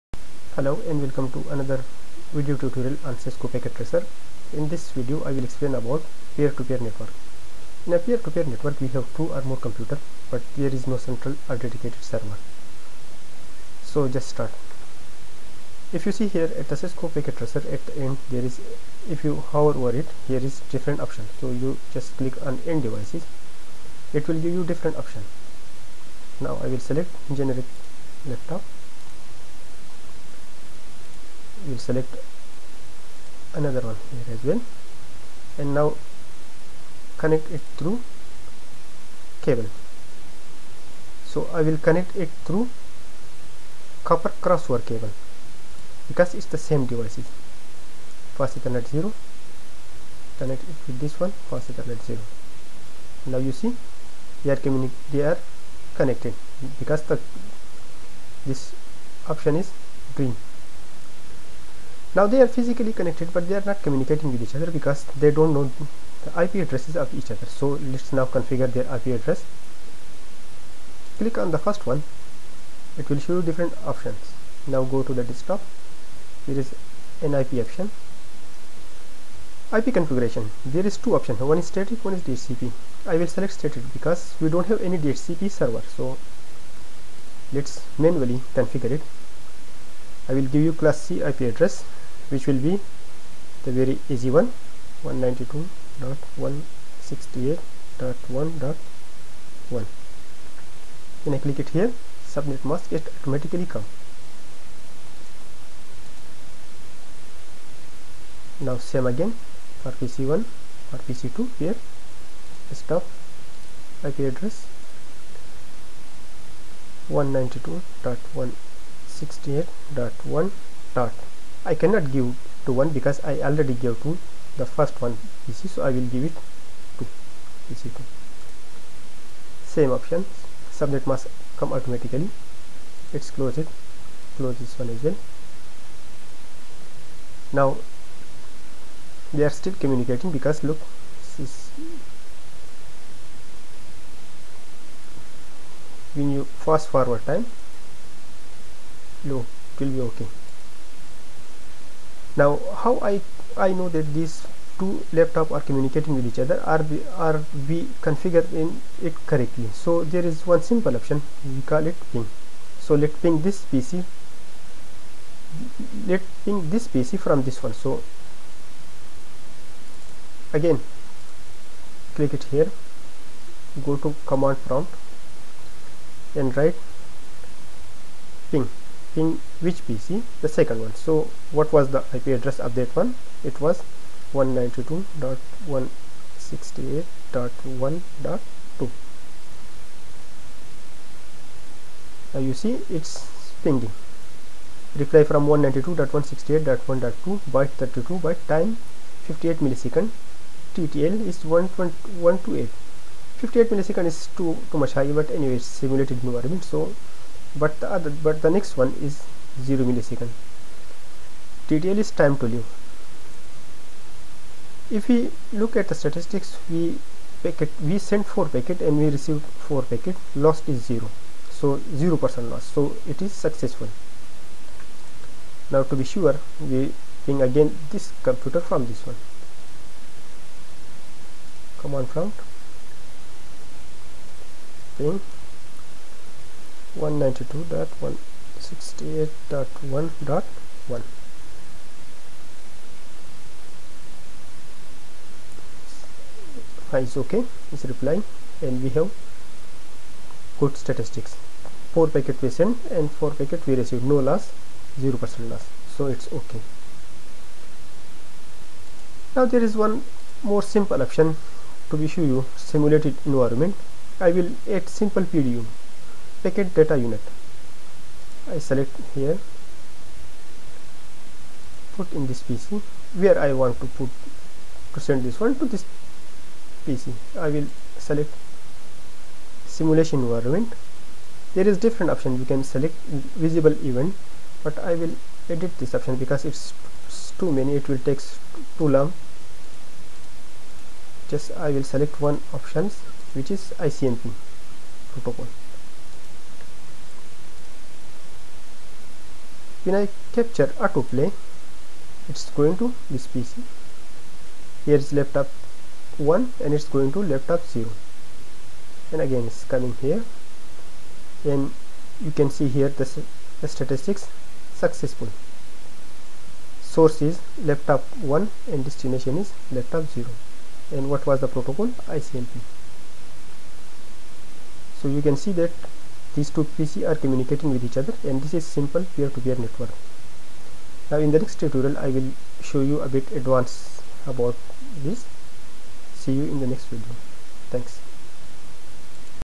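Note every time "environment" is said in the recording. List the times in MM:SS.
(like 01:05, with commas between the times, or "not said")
03:26, 04:23, 04:40.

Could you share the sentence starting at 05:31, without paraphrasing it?
Now in the next tutorial I will show you a bit advanced about this.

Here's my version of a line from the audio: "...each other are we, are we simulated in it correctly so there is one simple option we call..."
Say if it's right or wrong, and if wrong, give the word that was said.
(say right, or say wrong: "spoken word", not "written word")
wrong: "configured", not "simulated".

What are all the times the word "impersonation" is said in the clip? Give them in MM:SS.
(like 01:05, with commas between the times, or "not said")
not said.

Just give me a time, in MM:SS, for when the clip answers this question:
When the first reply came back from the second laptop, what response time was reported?
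03:18.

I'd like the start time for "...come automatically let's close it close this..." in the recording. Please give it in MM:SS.
02:11.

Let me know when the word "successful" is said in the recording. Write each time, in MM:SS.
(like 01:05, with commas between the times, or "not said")
03:43, 05:14.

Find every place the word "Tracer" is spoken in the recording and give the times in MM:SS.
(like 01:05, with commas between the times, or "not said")
00:03, 00:17.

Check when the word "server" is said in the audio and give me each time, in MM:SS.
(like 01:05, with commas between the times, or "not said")
00:12, 01:25.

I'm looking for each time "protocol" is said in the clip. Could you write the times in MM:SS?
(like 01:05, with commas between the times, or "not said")
04:55, 05:21.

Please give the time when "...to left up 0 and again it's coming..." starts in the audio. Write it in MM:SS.
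05:07.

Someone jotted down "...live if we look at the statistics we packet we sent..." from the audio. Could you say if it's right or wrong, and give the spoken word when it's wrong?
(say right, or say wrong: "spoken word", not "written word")
right.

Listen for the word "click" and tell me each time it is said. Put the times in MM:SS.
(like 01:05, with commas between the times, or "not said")
00:22, 01:11, 01:41, 02:52.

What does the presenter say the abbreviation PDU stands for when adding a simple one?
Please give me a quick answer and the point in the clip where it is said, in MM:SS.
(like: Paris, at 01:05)
Packet data unit, at 04:26.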